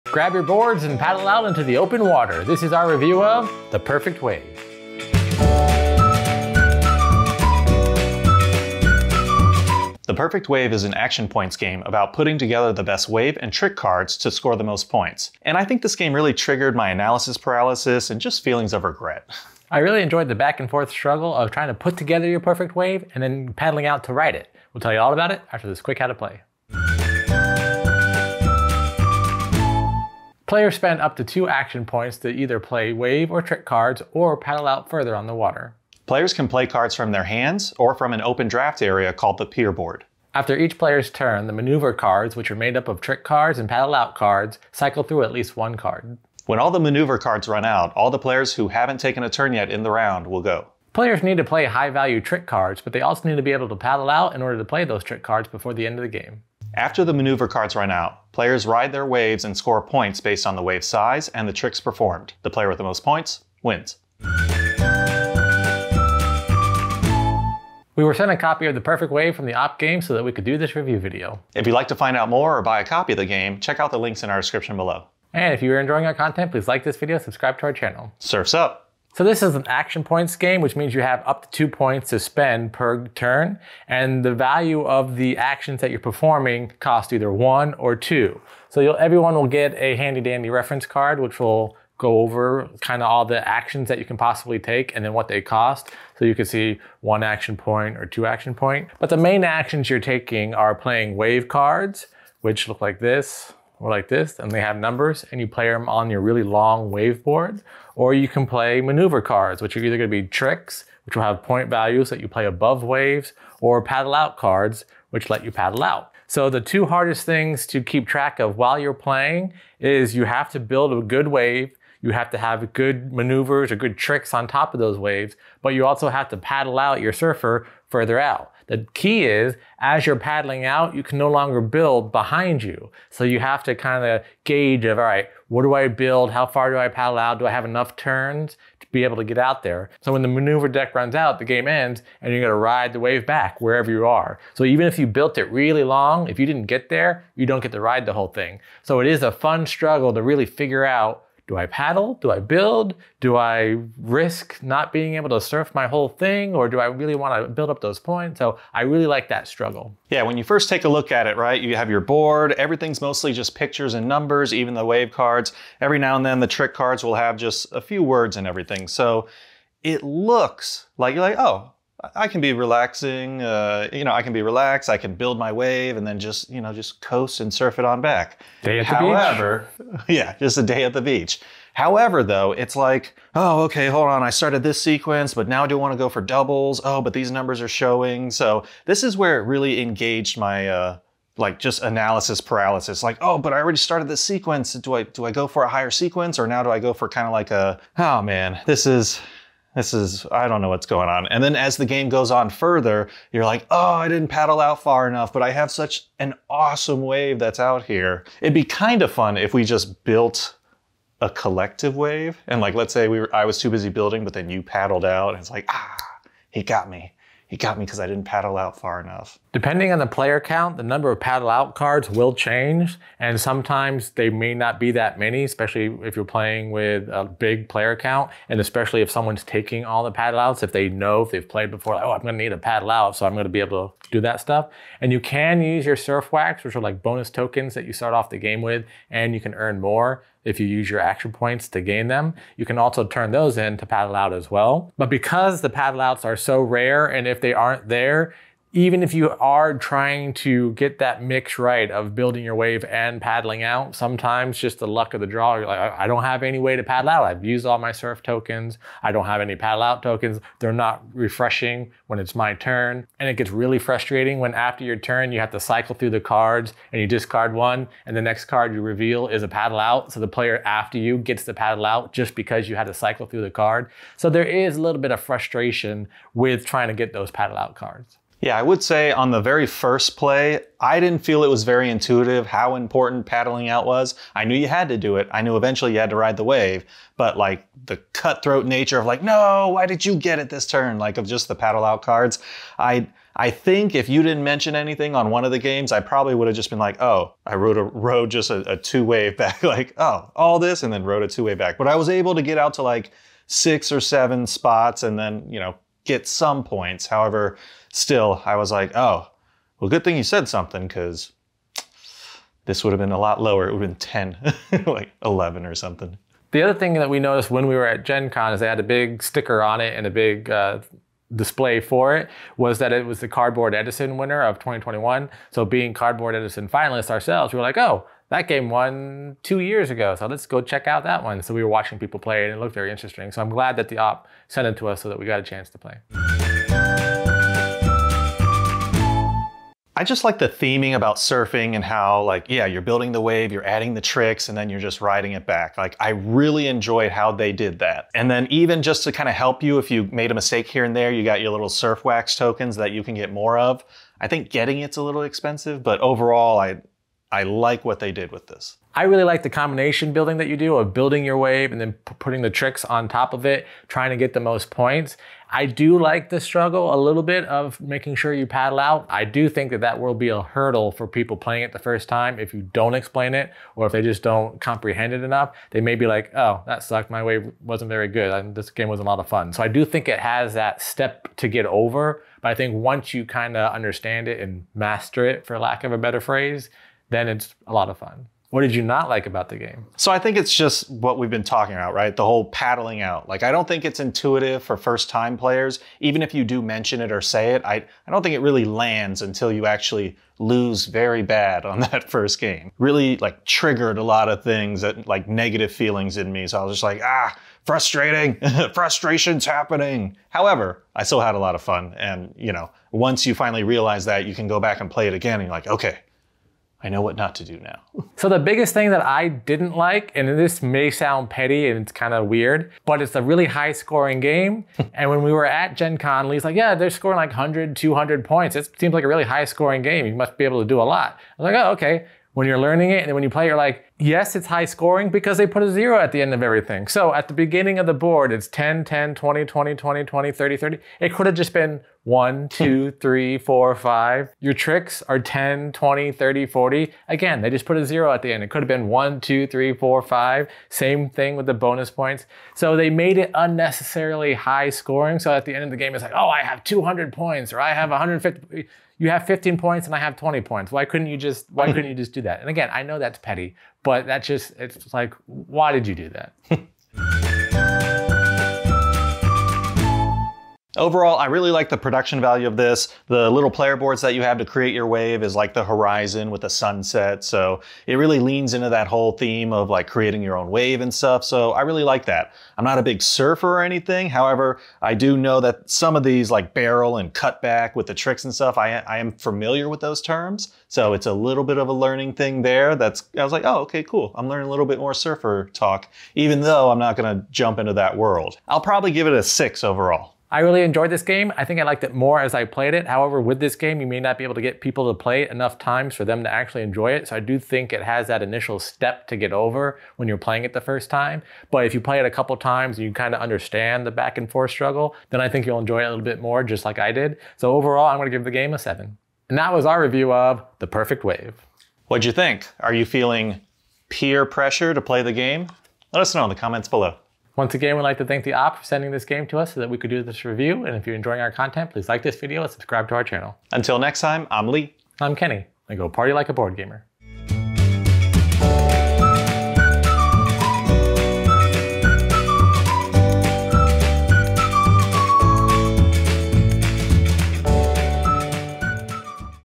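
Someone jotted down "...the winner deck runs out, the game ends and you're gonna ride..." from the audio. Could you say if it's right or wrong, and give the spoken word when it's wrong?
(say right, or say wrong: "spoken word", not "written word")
wrong: "maneuver", not "winner".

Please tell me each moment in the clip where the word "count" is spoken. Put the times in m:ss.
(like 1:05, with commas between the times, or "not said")
3:40, 3:47.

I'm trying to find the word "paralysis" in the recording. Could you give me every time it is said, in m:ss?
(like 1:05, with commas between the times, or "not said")
0:17, 3:12.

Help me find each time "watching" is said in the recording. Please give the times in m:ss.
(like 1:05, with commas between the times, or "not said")
5:31.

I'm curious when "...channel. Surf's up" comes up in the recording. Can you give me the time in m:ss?
1:17.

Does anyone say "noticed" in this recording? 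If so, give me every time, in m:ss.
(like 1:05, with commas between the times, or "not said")
5:17.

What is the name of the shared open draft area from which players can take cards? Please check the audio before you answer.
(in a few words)
pier board.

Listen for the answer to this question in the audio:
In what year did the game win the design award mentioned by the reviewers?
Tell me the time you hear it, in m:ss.
5:24.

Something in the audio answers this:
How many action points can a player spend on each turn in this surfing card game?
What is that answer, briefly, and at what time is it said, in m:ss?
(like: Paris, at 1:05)
2, at 0:31.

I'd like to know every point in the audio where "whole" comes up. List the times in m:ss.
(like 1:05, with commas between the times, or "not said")
2:28, 2:35, 6:32, 7:58.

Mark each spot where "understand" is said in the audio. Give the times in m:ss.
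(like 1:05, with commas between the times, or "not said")
6:23, 8:33.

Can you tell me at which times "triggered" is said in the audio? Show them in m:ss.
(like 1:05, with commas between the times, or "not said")
0:16, 6:43.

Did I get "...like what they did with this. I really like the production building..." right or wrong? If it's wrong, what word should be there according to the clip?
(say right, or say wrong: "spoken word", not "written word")
wrong: "combination", not "production".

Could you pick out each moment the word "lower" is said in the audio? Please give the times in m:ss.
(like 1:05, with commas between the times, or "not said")
5:13.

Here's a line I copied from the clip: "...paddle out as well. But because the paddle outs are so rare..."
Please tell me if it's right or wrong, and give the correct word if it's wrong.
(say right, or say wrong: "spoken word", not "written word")
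right.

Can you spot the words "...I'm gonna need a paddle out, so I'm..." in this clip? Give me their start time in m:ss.
3:52.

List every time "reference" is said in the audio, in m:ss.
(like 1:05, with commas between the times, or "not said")
1:30.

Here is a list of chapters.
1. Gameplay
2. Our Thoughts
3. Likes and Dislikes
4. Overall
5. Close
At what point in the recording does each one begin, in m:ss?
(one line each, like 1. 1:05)
1. 0:29
2. 1:06
3. 5:37
4. 7:50
5. 8:40.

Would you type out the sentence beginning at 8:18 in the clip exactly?
I'll probably give it a six overall.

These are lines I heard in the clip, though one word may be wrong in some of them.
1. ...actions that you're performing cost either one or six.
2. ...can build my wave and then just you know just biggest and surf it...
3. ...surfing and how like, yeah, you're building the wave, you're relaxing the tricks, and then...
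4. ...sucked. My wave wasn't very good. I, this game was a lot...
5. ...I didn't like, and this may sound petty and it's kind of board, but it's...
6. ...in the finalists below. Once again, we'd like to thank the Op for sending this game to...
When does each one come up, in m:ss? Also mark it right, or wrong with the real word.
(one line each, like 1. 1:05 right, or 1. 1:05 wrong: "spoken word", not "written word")
1. 1:25 wrong: "two", not "six"
2. 2:54 wrong: "coast", not "biggest"
3. 5:41 wrong: "adding", not "relaxing"
4. 6:16 right
5. 6:59 wrong: "weird", not "board"
6. 8:46 wrong: "comments", not "finalists".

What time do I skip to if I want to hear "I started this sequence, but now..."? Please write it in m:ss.
3:04.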